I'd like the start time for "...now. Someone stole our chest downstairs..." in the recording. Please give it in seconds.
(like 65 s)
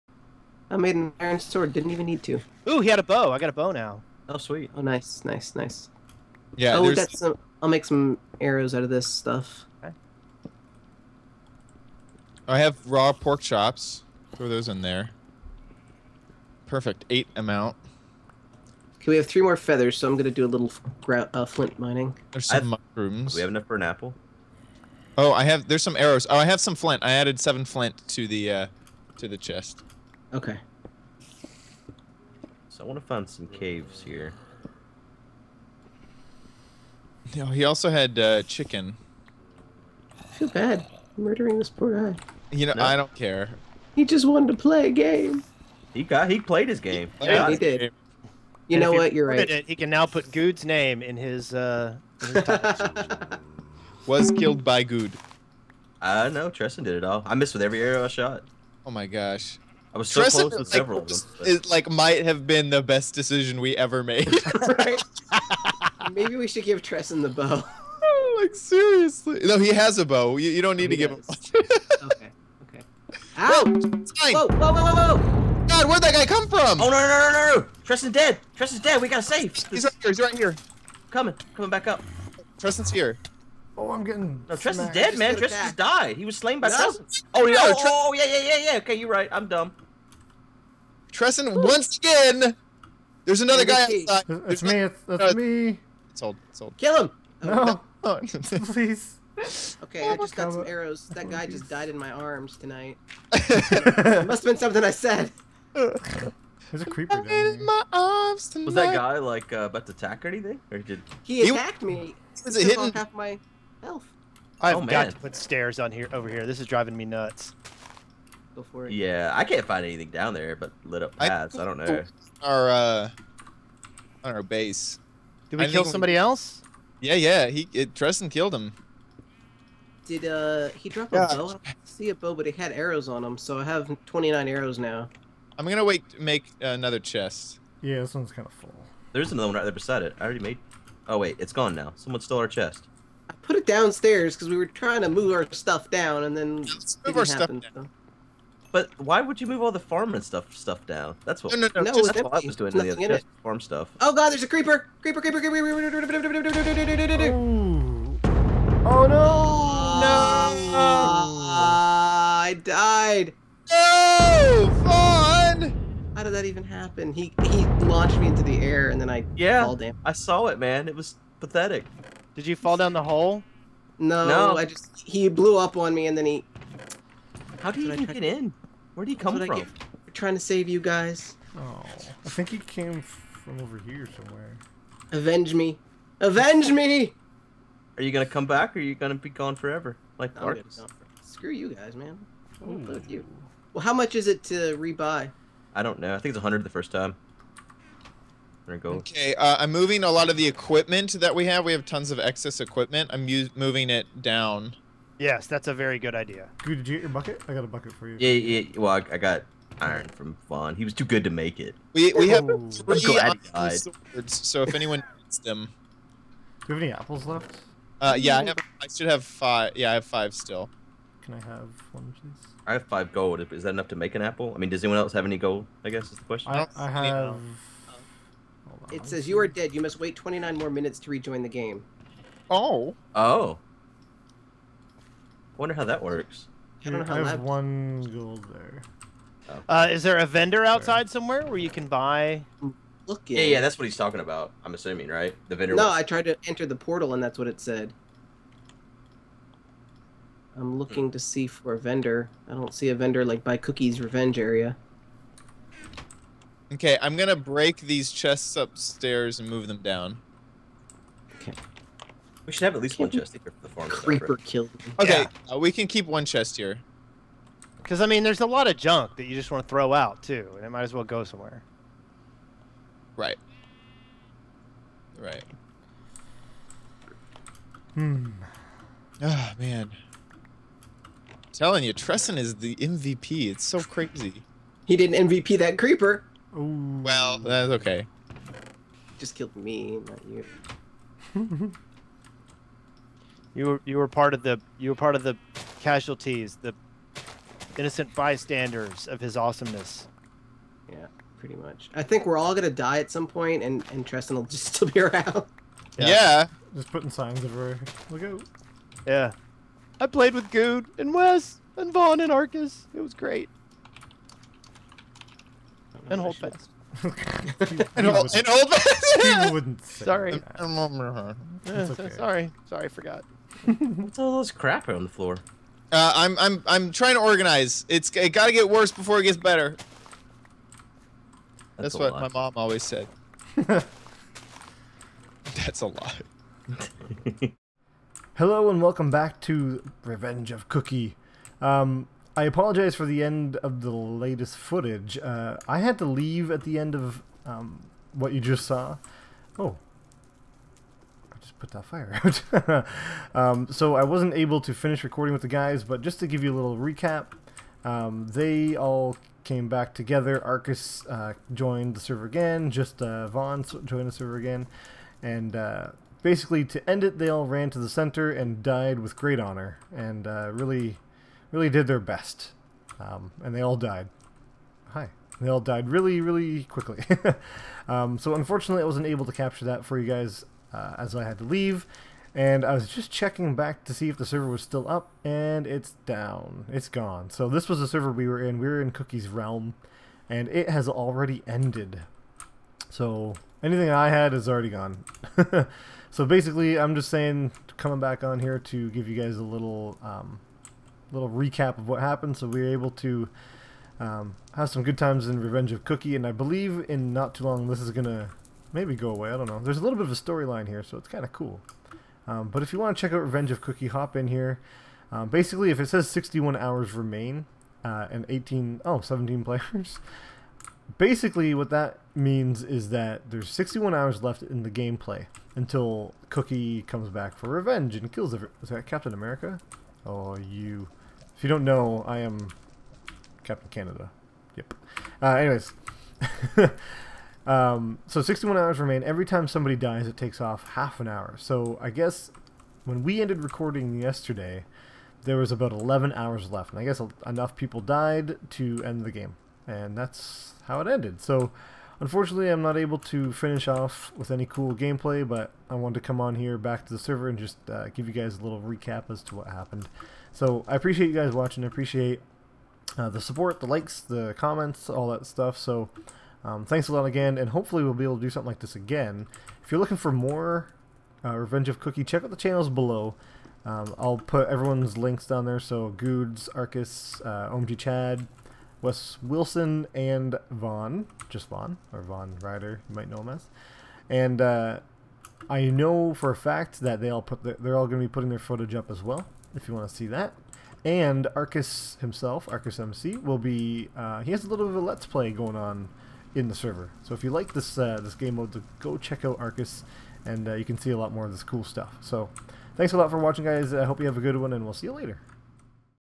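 141 s.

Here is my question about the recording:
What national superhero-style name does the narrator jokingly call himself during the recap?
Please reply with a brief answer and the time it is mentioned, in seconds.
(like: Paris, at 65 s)
Captain Canada, at 433 s.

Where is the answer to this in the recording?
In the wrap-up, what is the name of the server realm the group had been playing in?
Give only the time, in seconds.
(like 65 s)
388 s.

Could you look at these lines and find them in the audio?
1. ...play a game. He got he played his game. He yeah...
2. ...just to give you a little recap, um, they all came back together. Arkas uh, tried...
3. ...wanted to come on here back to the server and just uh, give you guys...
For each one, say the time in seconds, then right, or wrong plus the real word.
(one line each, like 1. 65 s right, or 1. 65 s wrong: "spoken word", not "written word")
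1. 44 s right
2. 356 s wrong: "joined", not "tried"
3. 455 s right.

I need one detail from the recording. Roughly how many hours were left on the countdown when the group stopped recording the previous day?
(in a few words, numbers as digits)
11.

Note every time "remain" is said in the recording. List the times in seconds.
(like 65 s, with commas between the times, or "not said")
416 s, 438 s.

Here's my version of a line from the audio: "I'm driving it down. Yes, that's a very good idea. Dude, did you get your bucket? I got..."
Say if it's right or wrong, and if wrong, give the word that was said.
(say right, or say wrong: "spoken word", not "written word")
wrong: "moving", not "driving".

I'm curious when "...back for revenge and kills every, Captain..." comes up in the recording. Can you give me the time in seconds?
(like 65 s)
427 s.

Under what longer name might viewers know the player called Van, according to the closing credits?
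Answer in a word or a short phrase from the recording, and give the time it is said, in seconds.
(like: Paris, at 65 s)
Van Ryder, at 482 s.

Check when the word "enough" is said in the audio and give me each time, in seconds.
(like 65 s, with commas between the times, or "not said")
23 s, 223 s, 447 s.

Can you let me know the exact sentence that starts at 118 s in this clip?
Yeah, I can't find anything down there but lit up paths.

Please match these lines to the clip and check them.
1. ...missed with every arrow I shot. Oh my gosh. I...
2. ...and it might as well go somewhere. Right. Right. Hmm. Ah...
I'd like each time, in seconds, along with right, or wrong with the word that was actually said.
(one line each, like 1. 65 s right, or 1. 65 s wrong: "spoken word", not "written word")
1. 57 s right
2. 270 s right.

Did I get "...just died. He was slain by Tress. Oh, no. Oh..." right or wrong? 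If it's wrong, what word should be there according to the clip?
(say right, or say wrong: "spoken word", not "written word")
right.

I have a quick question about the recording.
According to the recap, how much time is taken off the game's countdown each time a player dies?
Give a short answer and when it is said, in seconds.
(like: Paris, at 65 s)
half an hour, at 440 s.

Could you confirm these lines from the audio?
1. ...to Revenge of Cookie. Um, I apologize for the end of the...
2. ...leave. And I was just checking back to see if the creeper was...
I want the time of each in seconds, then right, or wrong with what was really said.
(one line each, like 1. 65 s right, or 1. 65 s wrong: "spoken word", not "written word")
1. 339 s right
2. 381 s wrong: "server", not "creeper".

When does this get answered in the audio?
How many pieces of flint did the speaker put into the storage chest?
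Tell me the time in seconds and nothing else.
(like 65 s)
27 s.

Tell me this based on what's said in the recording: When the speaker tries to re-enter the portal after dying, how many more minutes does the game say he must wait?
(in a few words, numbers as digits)
29.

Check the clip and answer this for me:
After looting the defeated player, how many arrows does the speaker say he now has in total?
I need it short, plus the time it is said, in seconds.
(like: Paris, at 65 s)
29, at 134 s.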